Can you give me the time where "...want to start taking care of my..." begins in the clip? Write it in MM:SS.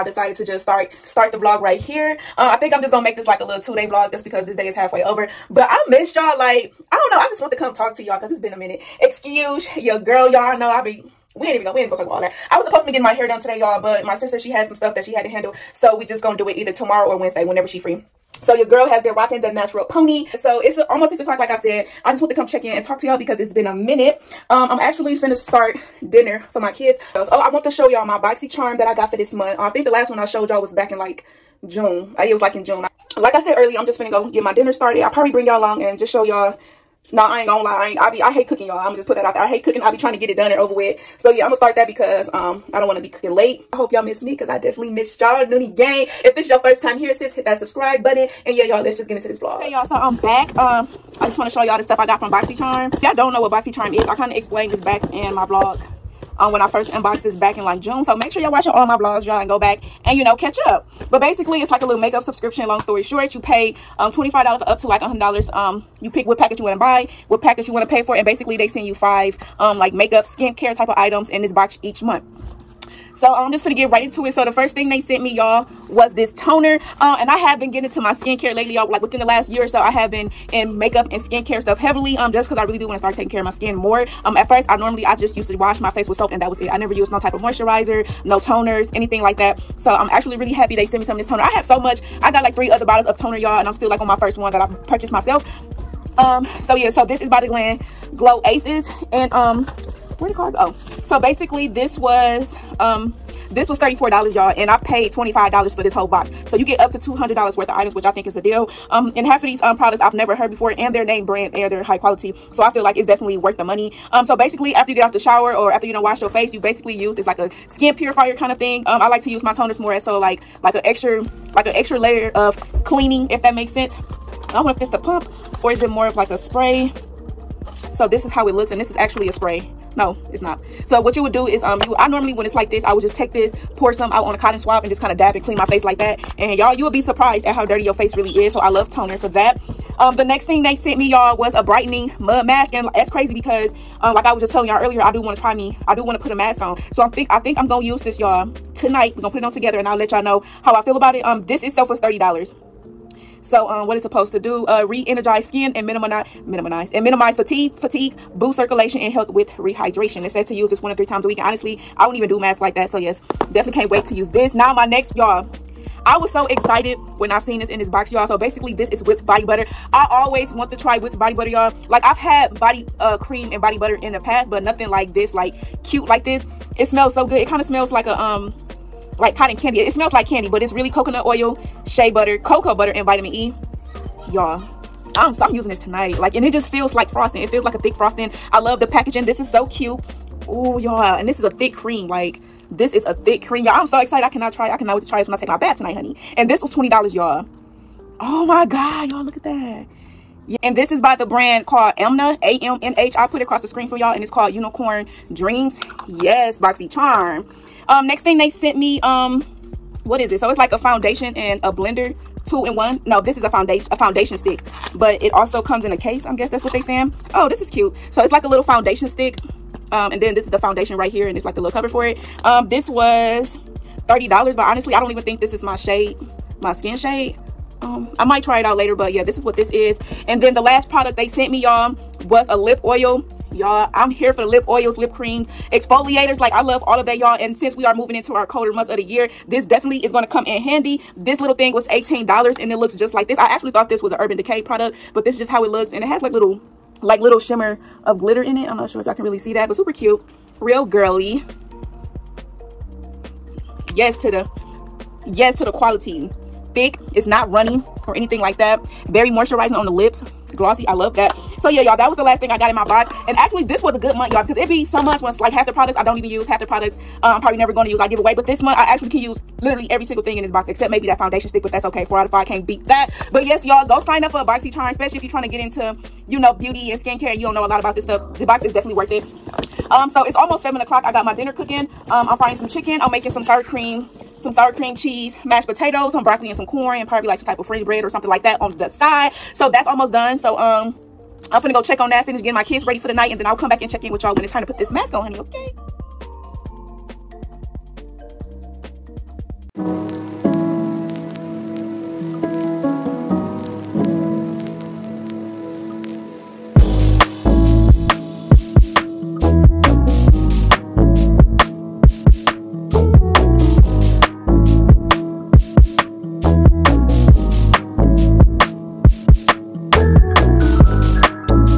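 01:22.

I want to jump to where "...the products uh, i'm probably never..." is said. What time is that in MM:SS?
04:26.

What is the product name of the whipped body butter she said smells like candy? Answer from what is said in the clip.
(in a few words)
Unicorn Dreams.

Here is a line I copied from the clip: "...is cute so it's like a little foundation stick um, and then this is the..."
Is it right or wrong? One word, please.
right.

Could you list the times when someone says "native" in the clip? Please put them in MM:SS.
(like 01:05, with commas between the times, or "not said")
not said.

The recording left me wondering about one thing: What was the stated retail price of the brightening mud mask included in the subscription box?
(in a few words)
$30.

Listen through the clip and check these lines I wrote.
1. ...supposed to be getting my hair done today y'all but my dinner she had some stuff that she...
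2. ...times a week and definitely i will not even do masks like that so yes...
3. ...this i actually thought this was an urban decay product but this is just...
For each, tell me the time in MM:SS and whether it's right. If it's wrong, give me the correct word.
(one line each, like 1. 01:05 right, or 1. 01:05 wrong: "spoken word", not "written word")
1. 00:12 wrong: "sister", not "dinner"
2. 02:41 wrong: "honestly", not "definitely"
3. 04:03 right.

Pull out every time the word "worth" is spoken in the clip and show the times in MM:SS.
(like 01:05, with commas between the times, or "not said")
01:47, 01:53, 04:38.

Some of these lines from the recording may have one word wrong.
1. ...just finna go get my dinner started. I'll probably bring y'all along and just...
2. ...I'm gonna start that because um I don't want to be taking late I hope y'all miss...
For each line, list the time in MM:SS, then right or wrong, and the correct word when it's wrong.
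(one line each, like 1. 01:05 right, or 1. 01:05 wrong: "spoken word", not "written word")
1. 00:33 right
2. 00:41 wrong: "cooking", not "taking".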